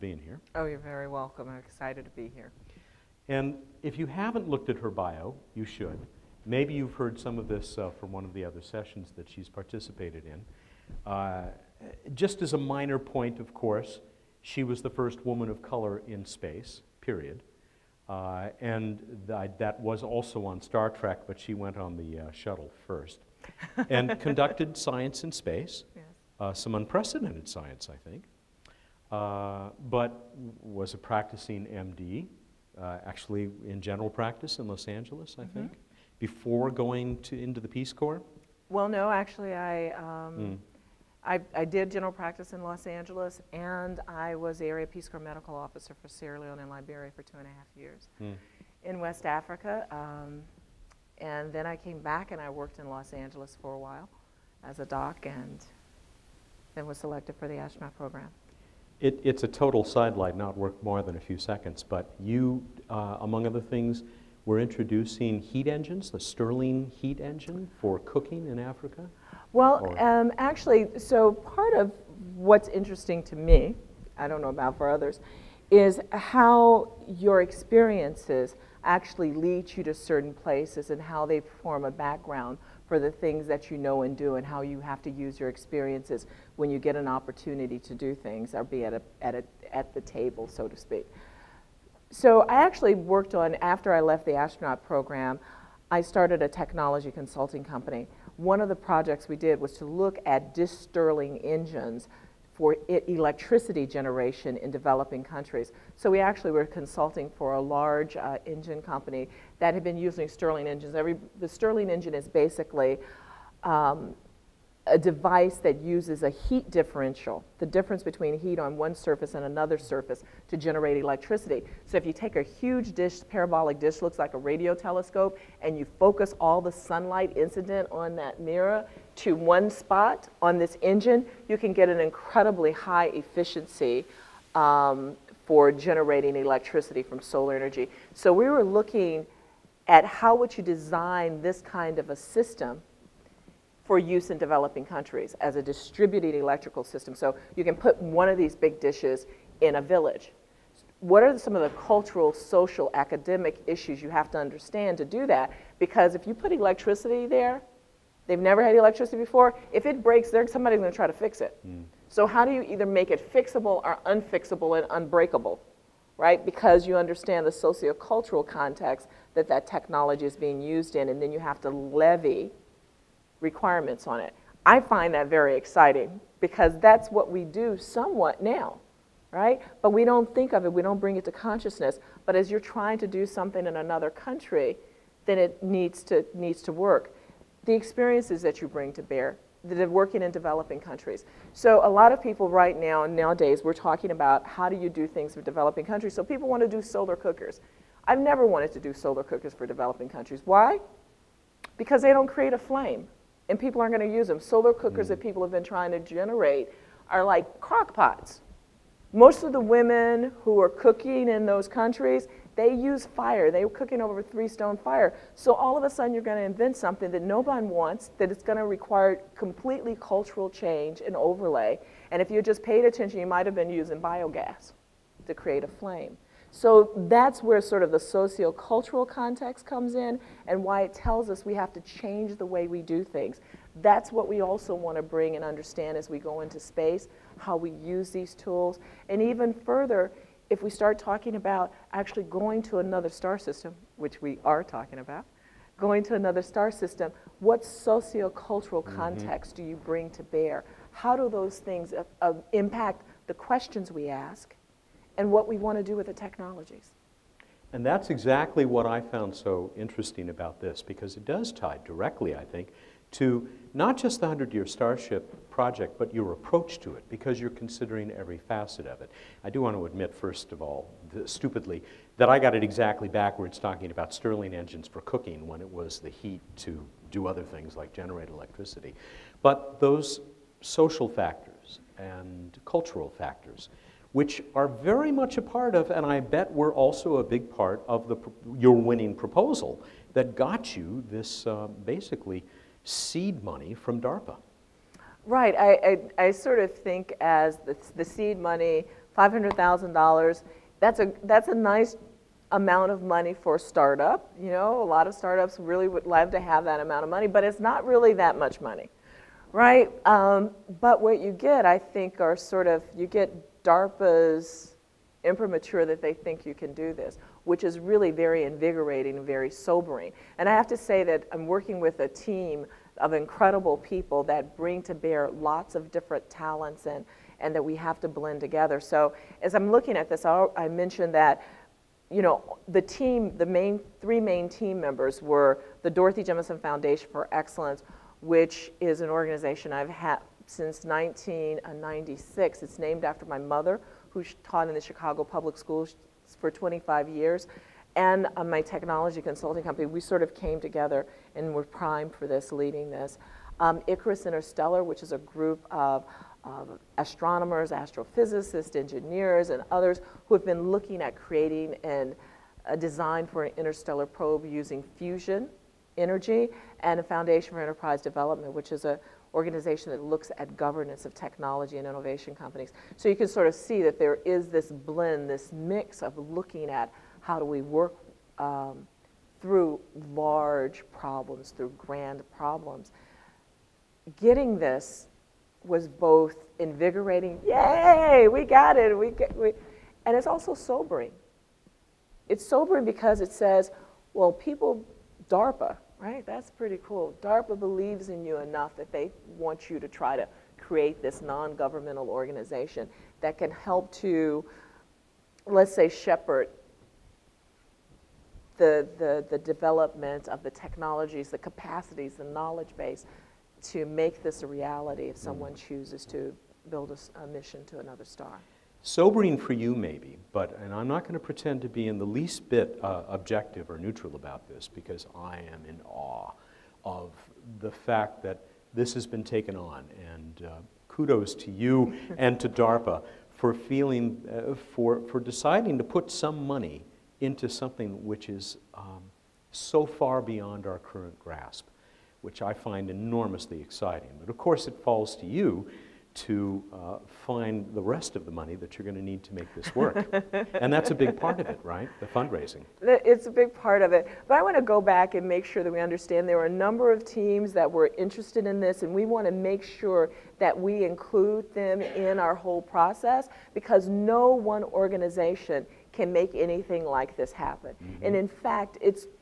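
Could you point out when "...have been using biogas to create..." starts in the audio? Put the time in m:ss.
3:43.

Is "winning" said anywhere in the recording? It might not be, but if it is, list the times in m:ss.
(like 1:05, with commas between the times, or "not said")
4:48.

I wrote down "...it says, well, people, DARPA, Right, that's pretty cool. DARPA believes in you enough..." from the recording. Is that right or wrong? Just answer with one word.
right.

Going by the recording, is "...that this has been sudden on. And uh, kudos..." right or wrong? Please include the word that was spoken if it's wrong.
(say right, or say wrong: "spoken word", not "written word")
wrong: "taken", not "sudden".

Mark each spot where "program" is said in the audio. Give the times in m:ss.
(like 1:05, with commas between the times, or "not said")
0:57, 1:34.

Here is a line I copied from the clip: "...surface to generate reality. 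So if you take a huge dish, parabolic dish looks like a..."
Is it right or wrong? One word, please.
wrong.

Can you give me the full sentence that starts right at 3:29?
Most of the women who are cooking in those countries, they use fire.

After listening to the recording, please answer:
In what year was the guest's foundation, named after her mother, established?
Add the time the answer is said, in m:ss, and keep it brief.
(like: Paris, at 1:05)
1996, at 5:40.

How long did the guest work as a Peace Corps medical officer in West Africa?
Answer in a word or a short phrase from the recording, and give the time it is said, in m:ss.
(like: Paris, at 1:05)
two and a half years, at 0:47.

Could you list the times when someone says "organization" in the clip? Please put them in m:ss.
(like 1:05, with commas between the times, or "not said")
5:39, 6:09, 6:42, 7:44.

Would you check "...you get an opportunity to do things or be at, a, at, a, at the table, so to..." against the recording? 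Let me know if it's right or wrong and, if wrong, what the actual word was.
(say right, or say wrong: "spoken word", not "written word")
right.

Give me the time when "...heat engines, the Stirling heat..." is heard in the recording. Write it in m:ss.
1:05.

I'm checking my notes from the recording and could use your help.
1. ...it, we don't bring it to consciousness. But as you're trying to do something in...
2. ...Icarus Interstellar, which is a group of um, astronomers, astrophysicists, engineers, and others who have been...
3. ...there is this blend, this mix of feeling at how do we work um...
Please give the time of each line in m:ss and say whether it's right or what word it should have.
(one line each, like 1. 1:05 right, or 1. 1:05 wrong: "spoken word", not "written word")
1. 3:00 right
2. 5:53 right
3. 6:13 wrong: "looking", not "feeling".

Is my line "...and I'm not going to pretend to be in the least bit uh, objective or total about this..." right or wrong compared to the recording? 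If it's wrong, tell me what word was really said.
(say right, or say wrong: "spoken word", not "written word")
wrong: "neutral", not "total".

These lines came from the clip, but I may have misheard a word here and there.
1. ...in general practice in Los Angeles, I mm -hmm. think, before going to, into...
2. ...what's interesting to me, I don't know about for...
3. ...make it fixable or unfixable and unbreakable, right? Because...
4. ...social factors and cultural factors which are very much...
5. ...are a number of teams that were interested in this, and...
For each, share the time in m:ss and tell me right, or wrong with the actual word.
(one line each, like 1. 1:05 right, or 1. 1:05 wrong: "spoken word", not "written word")
1. 0:33 right
2. 1:12 right
3. 2:42 right
4. 4:40 right
5. 7:36 right.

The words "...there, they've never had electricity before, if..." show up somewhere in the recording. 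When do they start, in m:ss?
2:37.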